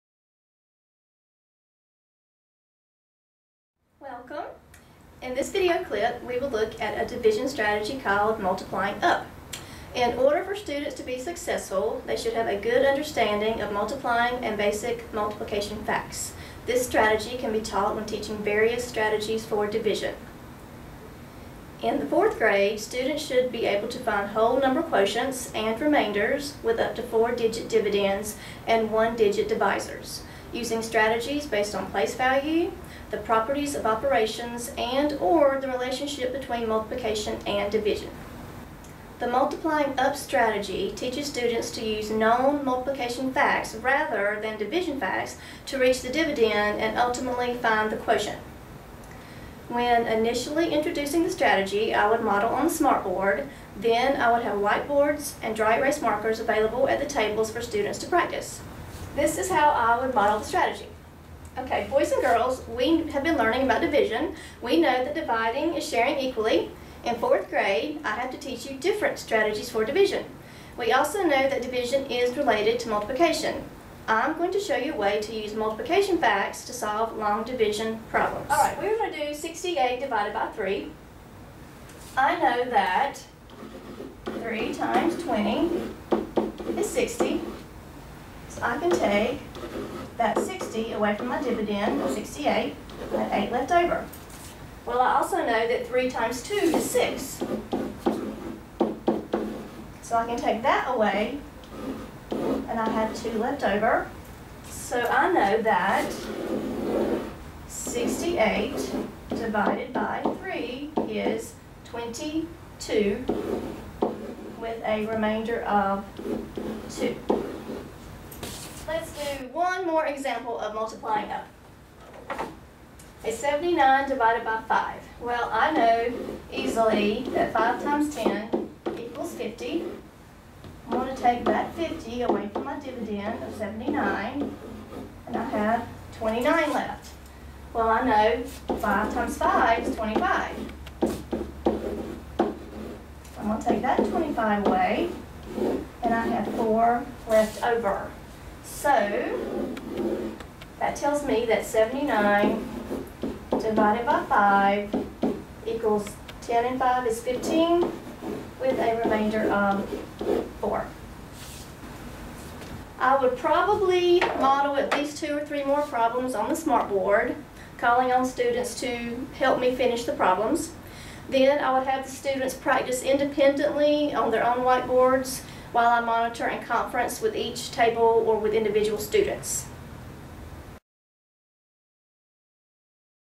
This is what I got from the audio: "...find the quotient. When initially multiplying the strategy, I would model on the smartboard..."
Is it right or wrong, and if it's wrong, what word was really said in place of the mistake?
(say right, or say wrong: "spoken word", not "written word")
wrong: "introducing", not "multiplying".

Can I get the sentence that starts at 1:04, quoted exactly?
We know that dividing is sharing equally.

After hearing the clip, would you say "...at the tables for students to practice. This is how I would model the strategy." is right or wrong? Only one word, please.
right.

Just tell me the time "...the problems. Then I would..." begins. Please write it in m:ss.
2:50.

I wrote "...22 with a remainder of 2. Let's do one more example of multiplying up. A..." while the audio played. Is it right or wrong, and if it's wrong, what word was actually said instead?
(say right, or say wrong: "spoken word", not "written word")
right.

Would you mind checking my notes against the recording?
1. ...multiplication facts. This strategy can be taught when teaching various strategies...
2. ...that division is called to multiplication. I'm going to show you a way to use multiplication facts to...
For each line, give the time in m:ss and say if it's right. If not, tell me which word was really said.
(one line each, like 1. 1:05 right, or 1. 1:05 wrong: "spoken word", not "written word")
1. 0:15 right
2. 1:11 wrong: "related", not "called".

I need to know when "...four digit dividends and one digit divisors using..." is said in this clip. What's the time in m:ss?
0:27.